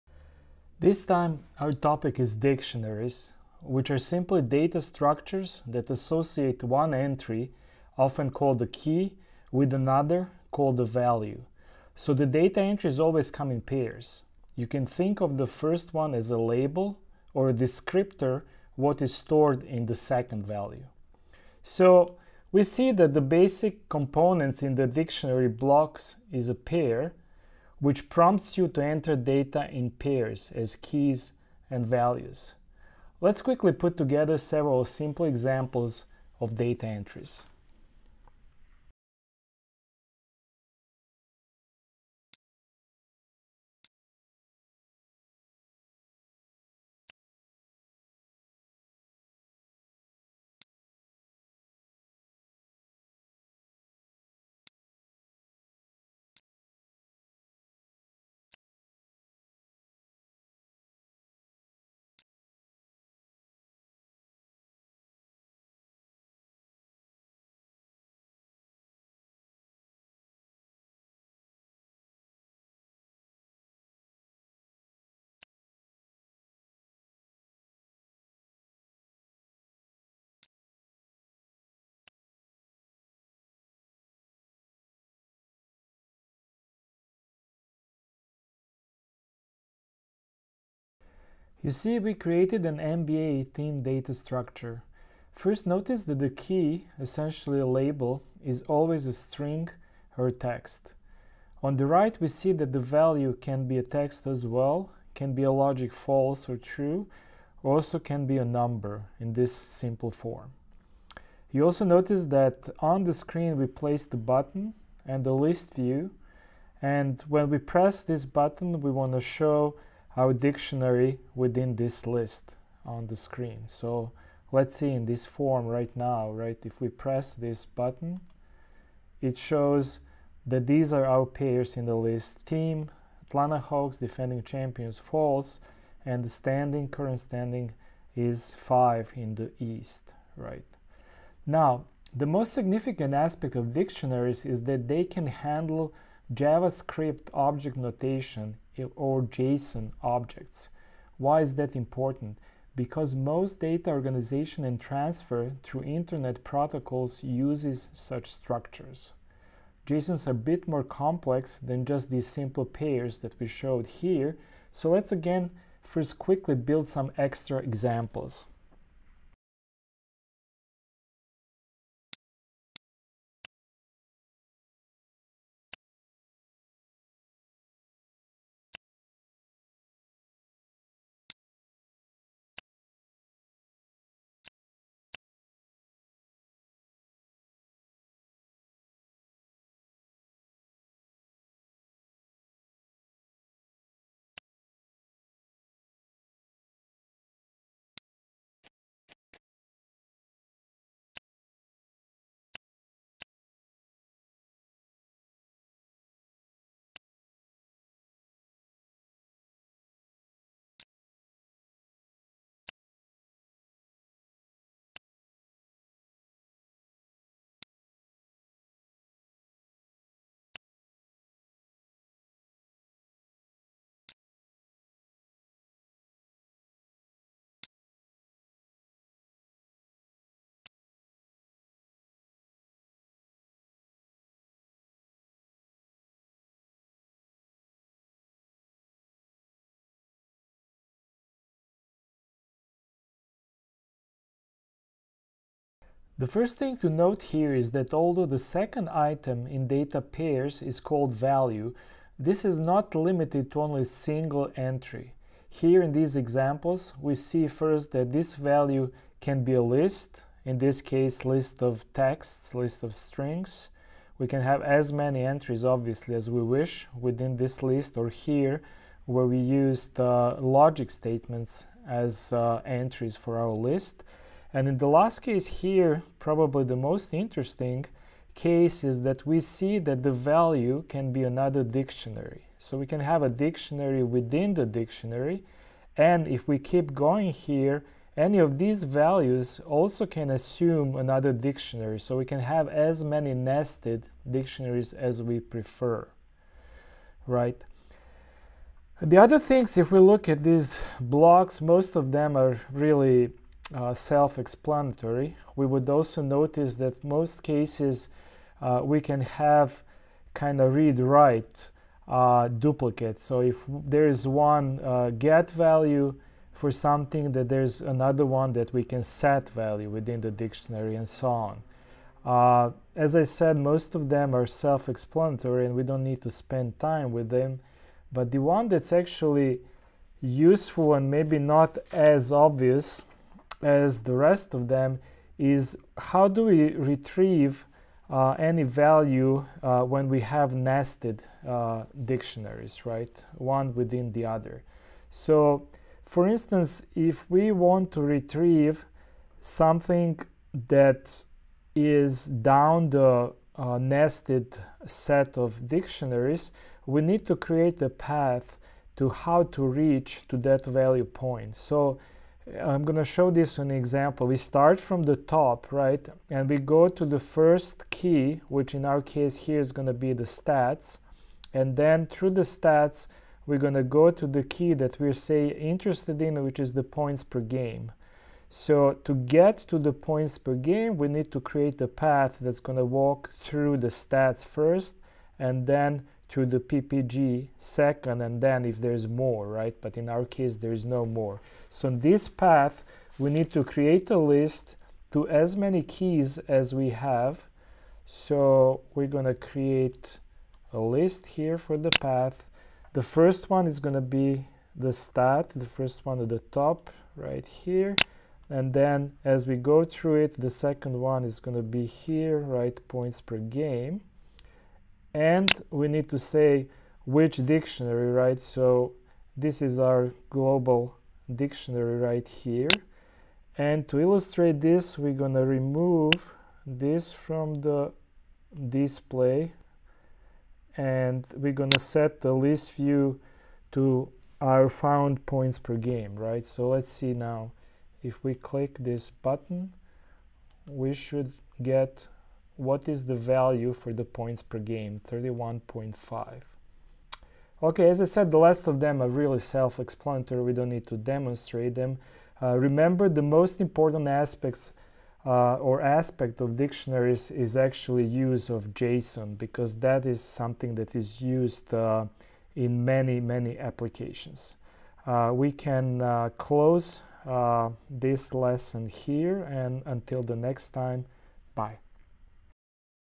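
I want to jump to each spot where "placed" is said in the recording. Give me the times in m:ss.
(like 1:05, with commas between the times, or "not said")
1:53.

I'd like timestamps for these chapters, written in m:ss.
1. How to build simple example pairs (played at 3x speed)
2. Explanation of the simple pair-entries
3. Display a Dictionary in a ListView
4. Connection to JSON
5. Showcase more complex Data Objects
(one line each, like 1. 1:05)
1. 0:33
2. 1:30
3. 1:53
4. 2:22
5. 2:44.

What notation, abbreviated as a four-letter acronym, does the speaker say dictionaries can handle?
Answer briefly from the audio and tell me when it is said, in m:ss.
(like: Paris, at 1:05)
JavaScript object notation, at 2:26.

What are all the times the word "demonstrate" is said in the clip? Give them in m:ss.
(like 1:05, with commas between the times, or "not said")
7:30.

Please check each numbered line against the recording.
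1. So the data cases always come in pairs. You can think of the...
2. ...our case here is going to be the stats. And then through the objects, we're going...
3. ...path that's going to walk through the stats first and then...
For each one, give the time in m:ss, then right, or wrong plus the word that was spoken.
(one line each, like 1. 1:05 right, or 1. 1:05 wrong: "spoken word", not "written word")
1. 0:11 wrong: "entries", not "cases"
2. 6:08 wrong: "stats", not "objects"
3. 6:21 right.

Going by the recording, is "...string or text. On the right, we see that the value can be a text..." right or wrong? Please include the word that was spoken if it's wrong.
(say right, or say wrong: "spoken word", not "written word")
right.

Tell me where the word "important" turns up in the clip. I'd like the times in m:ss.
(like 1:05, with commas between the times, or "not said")
2:31, 7:33.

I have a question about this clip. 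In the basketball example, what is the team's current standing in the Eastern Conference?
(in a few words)
5.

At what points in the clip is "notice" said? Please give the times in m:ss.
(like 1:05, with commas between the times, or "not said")
1:35, 1:51, 5:06.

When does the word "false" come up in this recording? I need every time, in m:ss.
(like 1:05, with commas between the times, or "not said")
1:45, 2:14.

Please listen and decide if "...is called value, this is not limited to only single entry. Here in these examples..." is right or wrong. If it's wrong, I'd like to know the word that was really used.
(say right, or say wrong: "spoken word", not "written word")
right.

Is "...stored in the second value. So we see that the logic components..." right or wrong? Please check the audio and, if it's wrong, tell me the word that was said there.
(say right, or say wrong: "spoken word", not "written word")
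wrong: "basic", not "logic".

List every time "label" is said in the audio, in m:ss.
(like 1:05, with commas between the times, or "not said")
0:16, 1:37.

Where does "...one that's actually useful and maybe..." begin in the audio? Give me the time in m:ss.
5:28.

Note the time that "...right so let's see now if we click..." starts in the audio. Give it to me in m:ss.
7:16.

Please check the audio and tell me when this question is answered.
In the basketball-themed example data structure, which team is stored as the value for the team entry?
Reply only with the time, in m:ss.
2:13.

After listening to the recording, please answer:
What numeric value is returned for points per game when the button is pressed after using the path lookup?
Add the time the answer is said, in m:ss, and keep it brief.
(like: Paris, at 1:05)
31.5, at 7:25.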